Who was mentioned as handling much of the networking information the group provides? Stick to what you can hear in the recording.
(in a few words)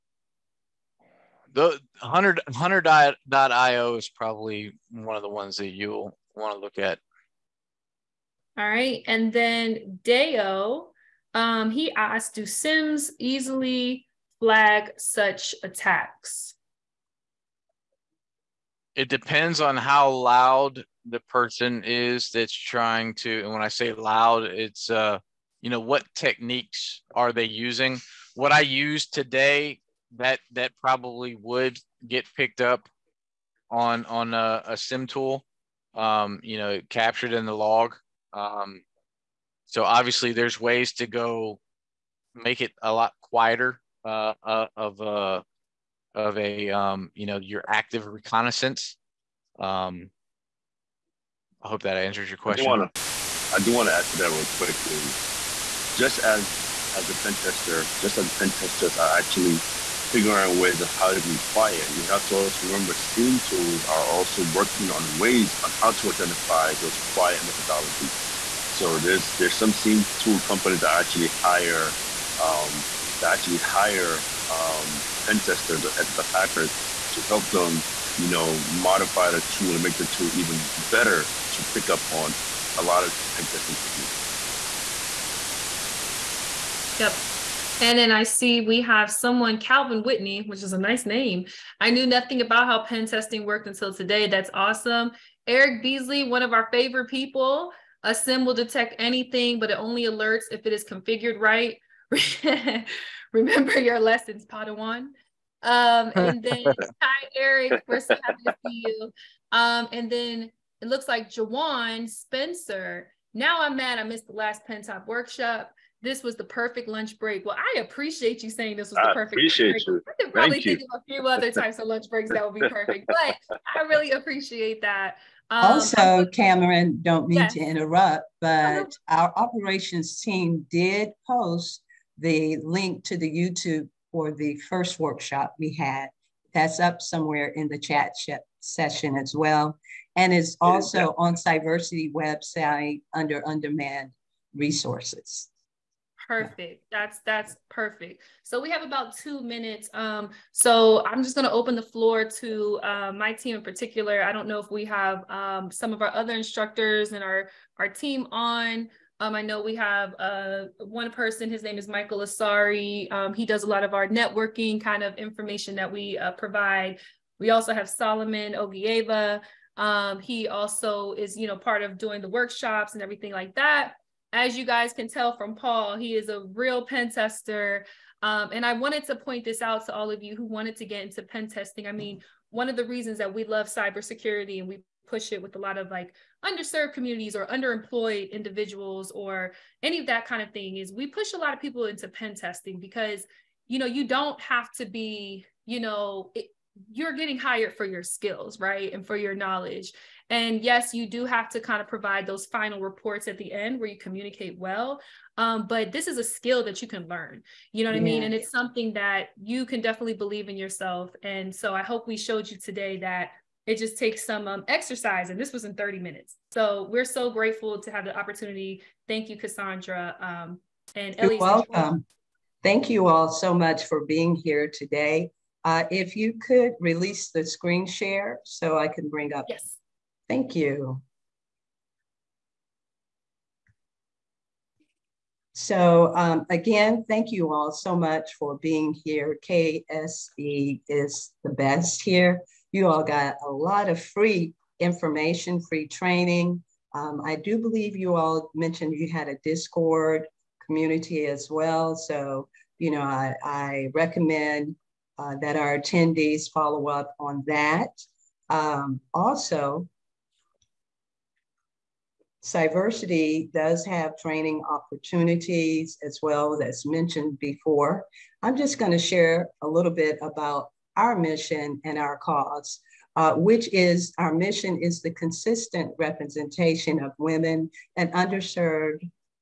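Michael Asari.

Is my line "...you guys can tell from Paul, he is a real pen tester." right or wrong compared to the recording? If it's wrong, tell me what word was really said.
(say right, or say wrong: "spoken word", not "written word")
right.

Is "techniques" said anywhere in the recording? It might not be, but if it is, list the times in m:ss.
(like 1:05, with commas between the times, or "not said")
0:26, 1:23.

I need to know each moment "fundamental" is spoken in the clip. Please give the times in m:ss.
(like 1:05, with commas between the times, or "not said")
not said.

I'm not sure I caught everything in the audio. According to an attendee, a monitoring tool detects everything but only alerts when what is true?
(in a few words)
configured right.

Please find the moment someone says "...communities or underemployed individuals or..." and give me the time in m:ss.
3:06.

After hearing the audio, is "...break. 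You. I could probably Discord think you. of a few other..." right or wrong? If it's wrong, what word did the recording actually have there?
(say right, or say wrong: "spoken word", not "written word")
wrong: "Thank", not "Discord".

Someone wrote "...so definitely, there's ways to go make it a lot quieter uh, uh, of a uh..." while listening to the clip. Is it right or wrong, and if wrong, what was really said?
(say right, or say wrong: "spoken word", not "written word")
wrong: "obviously", not "definitely".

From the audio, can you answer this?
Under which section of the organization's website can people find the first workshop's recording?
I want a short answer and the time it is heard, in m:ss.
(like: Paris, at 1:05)
on-demand resources, at 2:23.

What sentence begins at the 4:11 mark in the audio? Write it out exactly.
So, you know, I, I recommend uh, that our attendees follow up on that.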